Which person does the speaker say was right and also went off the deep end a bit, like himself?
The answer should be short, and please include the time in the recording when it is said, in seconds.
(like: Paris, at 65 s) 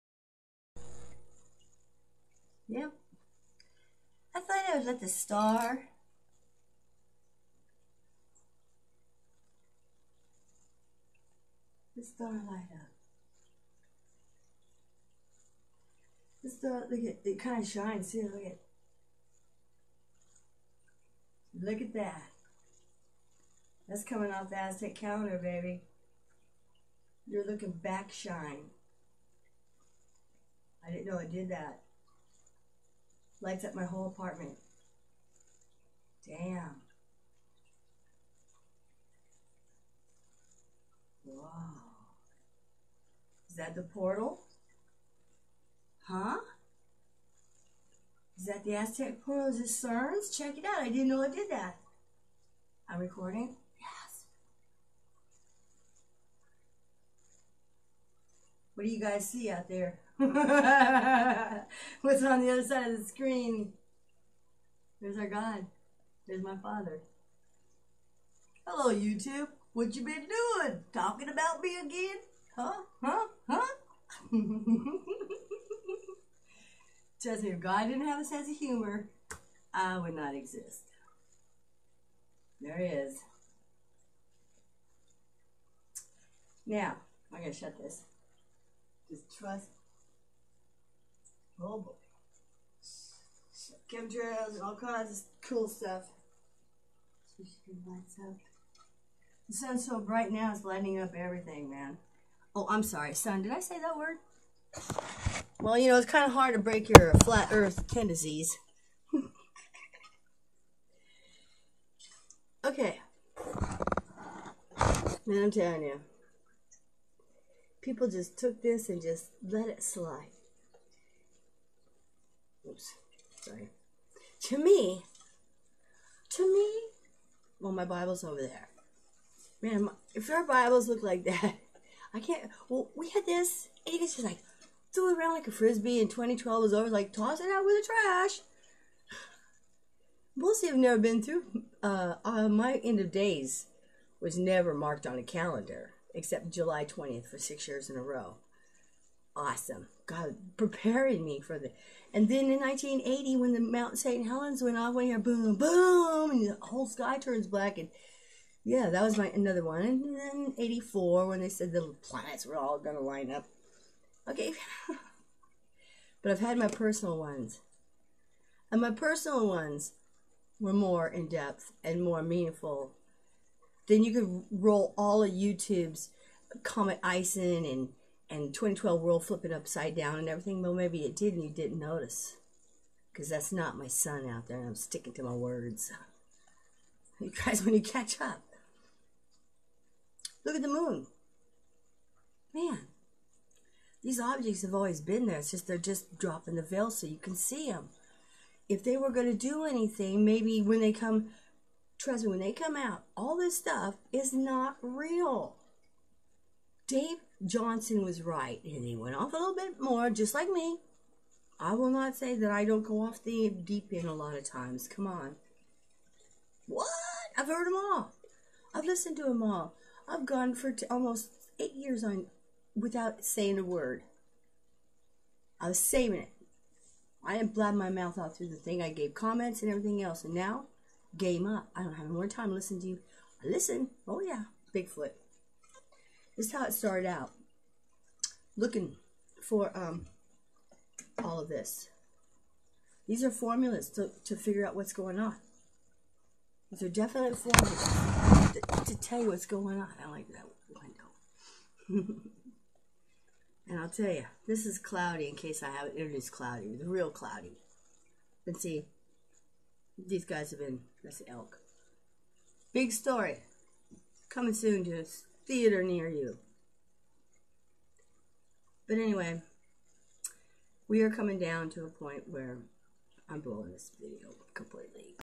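Dave Johnson, at 206 s.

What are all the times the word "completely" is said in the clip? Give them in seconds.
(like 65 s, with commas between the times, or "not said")
274 s.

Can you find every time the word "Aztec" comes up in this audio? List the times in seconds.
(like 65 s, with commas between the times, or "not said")
24 s, 48 s.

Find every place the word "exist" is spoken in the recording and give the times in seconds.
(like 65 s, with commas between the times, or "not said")
80 s.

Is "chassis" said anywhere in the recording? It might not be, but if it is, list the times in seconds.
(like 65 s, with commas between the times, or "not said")
not said.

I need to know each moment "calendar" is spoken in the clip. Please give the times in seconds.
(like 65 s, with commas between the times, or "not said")
24 s, 145 s.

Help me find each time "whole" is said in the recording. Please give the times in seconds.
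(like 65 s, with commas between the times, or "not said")
33 s, 156 s.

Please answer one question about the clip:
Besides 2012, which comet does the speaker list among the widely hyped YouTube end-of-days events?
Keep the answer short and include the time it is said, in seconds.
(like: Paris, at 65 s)
Comet Ison, at 176 s.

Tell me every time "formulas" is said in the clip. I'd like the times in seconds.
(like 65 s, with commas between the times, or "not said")
243 s, 247 s.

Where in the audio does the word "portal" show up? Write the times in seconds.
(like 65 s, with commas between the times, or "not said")
43 s, 49 s.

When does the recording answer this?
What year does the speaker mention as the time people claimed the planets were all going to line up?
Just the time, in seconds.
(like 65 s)
160 s.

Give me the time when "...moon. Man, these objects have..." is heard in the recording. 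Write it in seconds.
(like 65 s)
190 s.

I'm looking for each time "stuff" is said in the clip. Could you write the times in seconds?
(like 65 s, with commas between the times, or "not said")
95 s, 203 s.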